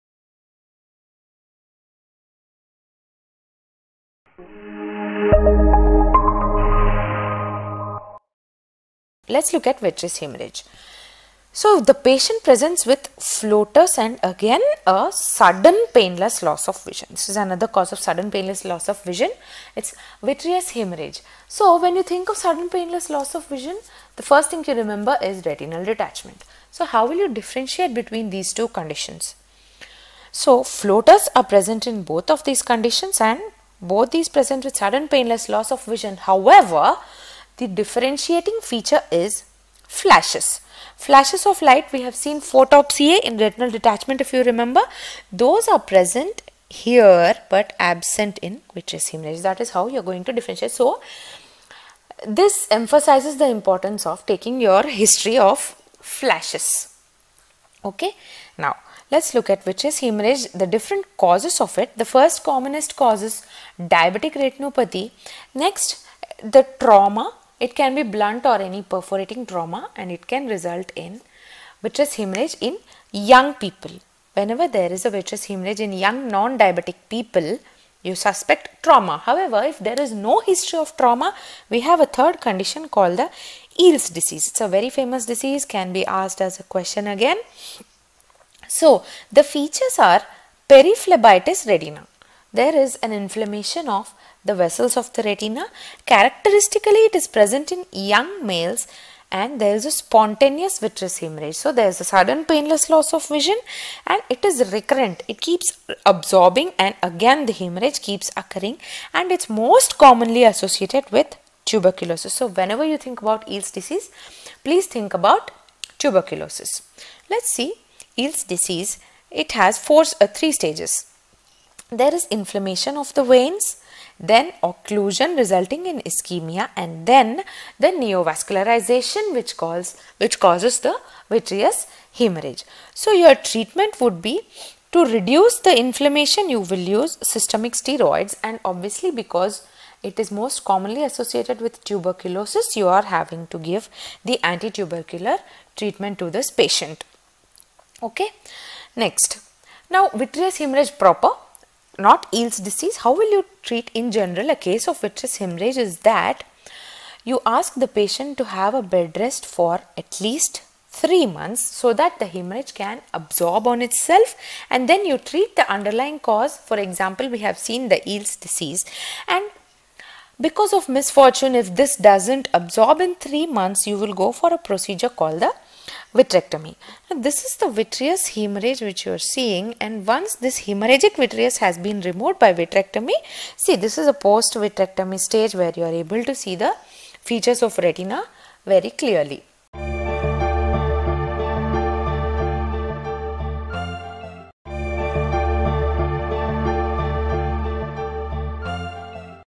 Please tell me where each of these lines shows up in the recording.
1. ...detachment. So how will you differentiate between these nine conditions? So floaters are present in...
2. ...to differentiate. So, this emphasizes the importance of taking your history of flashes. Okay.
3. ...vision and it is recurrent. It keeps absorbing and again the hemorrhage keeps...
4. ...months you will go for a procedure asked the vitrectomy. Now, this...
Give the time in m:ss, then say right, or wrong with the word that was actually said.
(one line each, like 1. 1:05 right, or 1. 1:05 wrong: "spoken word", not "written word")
1. 0:25 wrong: "two", not "nine"
2. 0:50 right
3. 1:43 right
4. 2:53 wrong: "called", not "asked".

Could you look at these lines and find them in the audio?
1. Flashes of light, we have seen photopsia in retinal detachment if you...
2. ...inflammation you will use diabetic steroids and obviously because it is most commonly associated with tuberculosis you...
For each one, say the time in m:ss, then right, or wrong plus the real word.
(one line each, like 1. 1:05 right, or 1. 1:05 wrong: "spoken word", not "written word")
1. 0:40 right
2. 2:15 wrong: "systemic", not "diabetic".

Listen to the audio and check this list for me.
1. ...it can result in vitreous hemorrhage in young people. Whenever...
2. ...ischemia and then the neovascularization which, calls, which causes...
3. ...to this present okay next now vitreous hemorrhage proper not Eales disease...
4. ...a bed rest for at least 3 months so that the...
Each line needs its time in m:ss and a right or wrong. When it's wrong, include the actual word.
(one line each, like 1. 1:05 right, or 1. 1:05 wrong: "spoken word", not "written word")
1. 1:10 right
2. 2:06 right
3. 2:26 wrong: "patient", not "present"
4. 2:38 right.